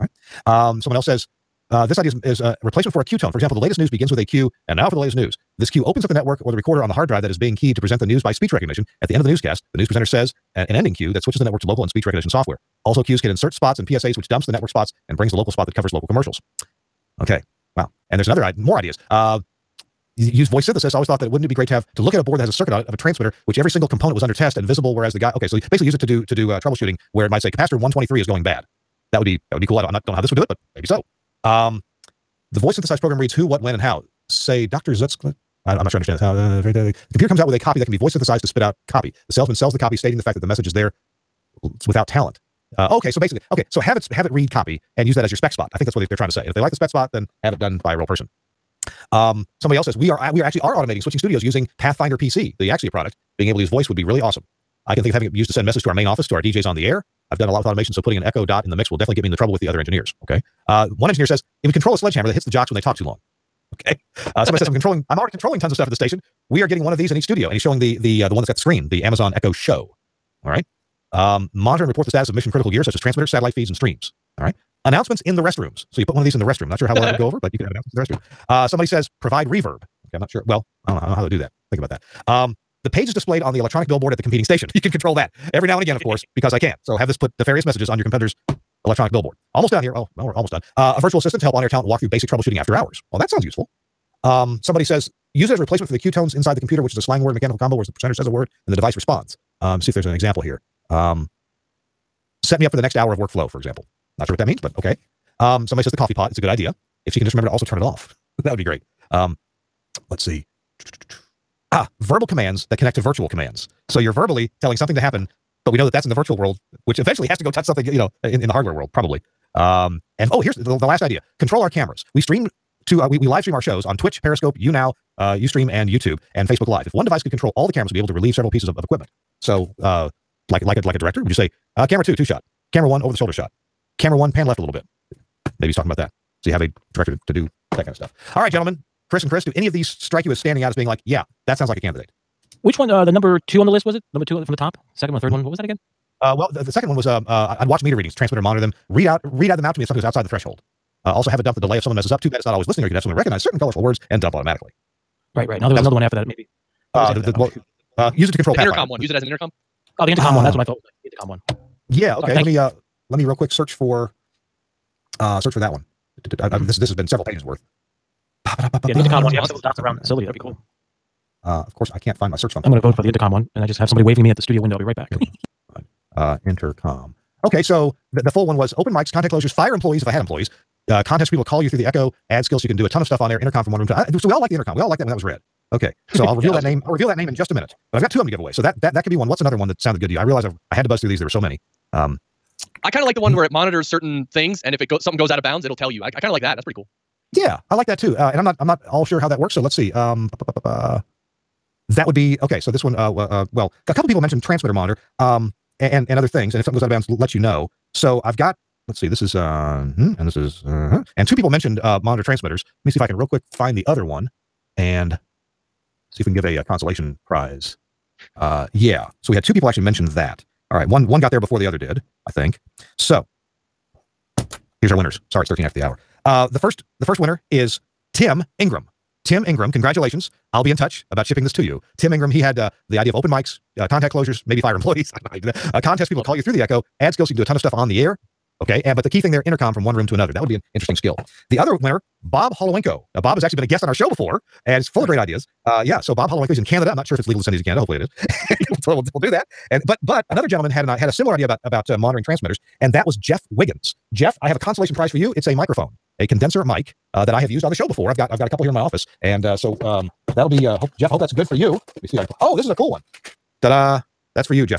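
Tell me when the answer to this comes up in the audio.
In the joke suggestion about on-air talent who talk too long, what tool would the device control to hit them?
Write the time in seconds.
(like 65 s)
61 s.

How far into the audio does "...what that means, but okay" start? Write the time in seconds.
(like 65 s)
104 s.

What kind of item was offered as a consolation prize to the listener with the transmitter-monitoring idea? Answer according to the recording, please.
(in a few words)
Condenser mic.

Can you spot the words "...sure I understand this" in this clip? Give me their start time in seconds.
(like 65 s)
35 s.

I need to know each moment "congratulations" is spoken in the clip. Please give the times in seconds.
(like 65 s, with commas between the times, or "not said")
229 s.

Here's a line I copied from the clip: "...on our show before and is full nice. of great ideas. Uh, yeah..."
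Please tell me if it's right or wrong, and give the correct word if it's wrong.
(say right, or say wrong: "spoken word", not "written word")
right.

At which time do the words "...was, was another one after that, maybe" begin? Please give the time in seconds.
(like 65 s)
155 s.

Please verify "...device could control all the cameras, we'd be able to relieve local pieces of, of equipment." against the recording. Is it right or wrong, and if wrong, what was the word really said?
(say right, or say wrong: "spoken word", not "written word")
wrong: "several", not "local".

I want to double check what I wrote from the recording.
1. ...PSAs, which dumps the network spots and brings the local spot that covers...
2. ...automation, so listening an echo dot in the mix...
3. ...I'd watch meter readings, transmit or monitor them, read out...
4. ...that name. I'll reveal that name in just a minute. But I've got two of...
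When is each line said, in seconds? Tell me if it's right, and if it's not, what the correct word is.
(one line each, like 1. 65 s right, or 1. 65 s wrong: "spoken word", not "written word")
1. 13 s right
2. 57 s wrong: "putting", not "listening"
3. 147 s right
4. 186 s right.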